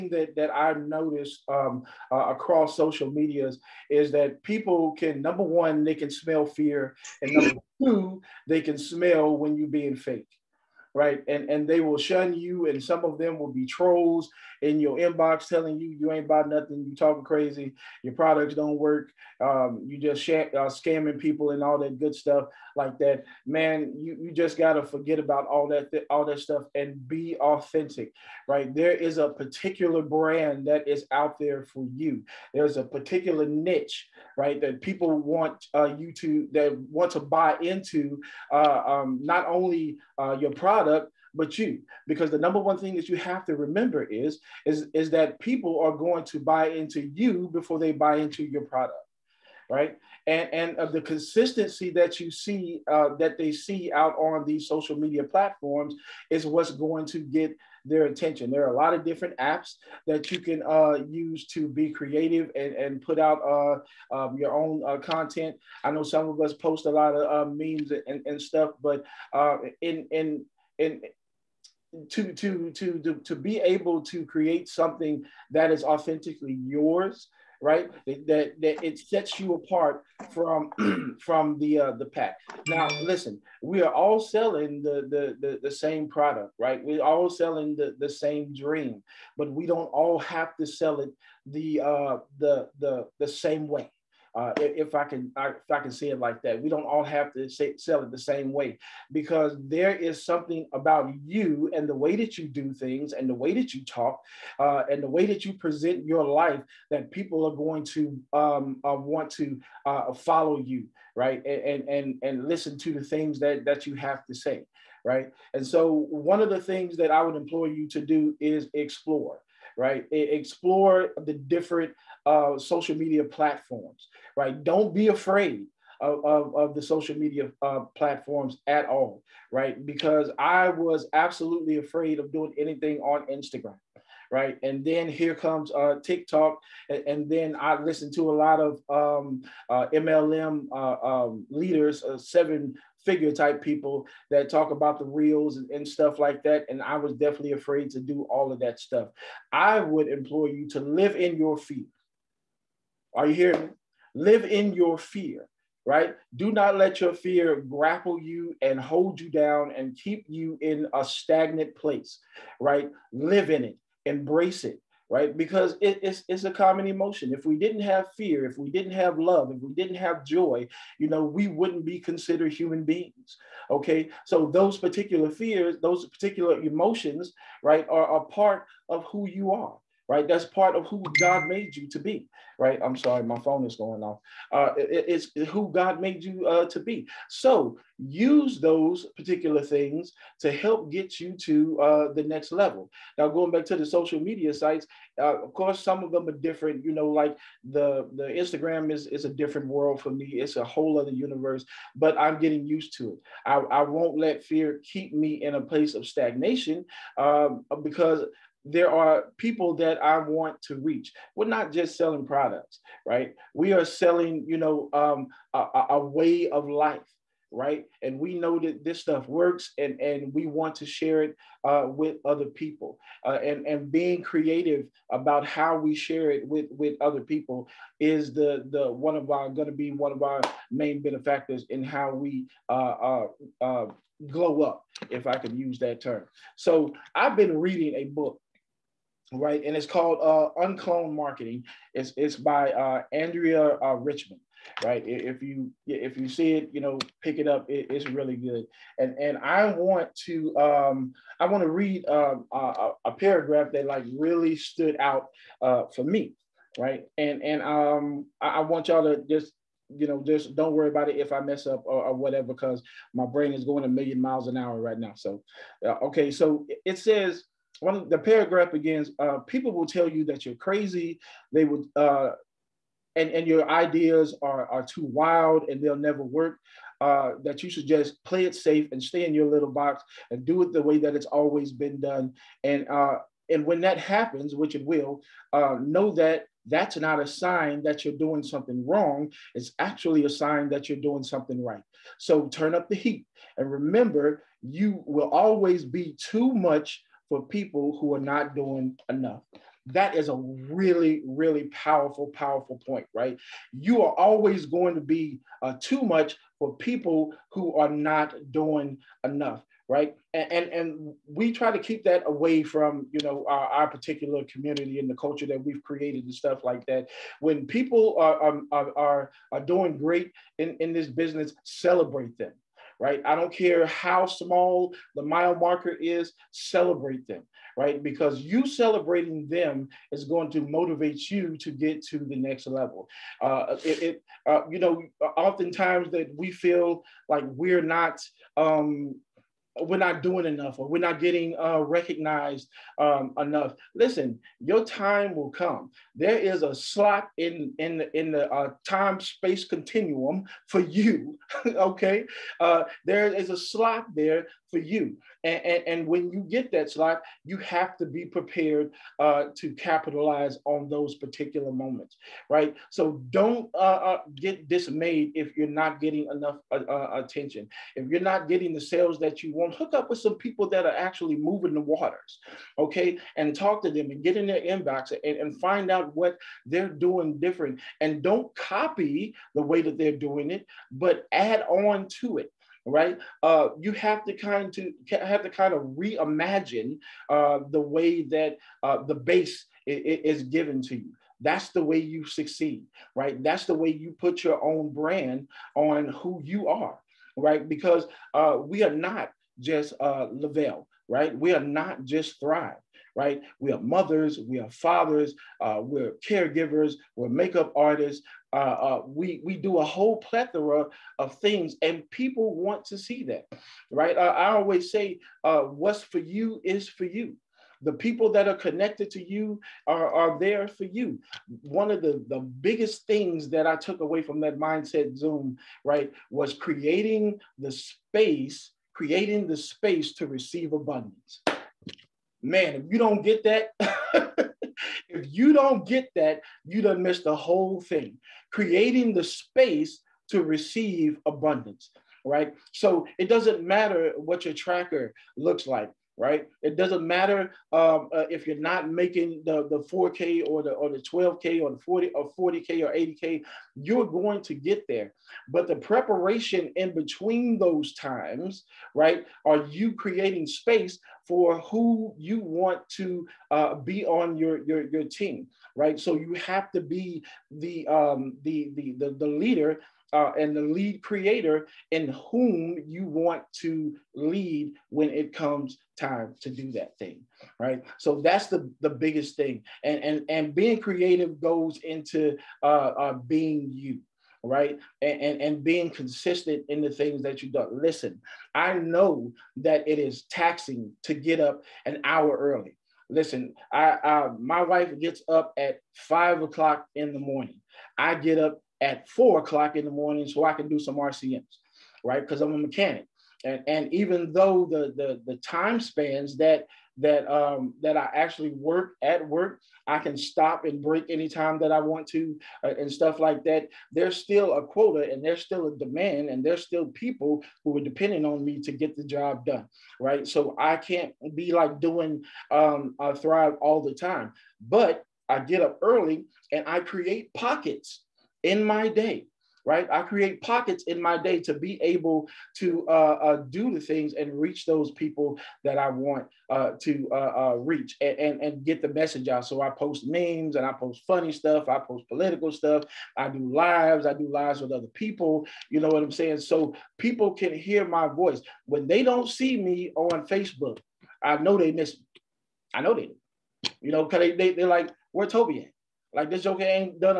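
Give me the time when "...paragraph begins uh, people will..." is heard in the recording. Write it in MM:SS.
04:28.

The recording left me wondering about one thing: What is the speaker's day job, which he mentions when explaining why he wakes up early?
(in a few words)
mechanic.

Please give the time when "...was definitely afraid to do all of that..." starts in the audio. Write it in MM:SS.
02:26.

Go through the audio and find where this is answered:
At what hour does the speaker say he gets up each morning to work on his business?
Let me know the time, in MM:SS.
08:19.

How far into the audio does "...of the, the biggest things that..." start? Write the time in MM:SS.
07:01.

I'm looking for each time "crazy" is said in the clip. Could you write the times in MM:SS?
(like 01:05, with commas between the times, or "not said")
00:17, 04:30.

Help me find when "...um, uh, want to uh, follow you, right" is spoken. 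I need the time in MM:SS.
01:48.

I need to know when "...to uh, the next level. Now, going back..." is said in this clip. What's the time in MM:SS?
03:11.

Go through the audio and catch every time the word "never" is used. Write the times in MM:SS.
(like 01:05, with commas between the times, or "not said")
04:35.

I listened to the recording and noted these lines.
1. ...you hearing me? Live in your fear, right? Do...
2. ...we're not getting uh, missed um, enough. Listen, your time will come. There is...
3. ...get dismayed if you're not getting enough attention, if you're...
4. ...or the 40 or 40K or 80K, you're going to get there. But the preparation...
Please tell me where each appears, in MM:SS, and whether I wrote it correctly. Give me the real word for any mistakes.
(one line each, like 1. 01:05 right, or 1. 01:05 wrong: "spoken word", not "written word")
1. 02:33 right
2. 05:40 wrong: "recognized", not "missed"
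3. 06:04 right
4. 07:31 right.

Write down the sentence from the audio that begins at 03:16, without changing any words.
You know, like the the Instagram is is a different world for me.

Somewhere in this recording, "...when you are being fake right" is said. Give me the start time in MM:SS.
00:09.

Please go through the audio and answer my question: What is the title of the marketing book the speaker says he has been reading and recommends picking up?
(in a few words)
Unclone Marketing.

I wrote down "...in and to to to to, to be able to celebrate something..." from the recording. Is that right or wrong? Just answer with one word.
wrong.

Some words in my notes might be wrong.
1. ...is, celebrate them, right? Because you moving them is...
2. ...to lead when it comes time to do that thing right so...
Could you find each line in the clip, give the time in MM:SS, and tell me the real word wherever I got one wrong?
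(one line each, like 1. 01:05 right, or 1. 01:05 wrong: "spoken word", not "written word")
1. 05:25 wrong: "celebrating", not "moving"
2. 07:53 right.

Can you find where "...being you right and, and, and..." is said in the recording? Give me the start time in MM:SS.
08:03.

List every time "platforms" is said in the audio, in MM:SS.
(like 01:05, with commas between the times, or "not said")
00:55, 02:03, 02:07.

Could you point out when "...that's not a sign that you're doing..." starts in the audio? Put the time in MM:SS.
04:46.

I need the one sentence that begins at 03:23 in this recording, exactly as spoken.
I, I won't let fear keep me in a place of stagnation um, because there are people that I want to reach.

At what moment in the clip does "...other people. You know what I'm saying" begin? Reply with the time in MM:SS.
09:04.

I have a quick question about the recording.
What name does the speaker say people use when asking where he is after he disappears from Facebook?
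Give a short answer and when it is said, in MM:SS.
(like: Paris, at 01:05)
Toby, at 09:15.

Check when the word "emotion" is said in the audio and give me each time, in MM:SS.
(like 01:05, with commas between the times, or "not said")
02:46, 02:56.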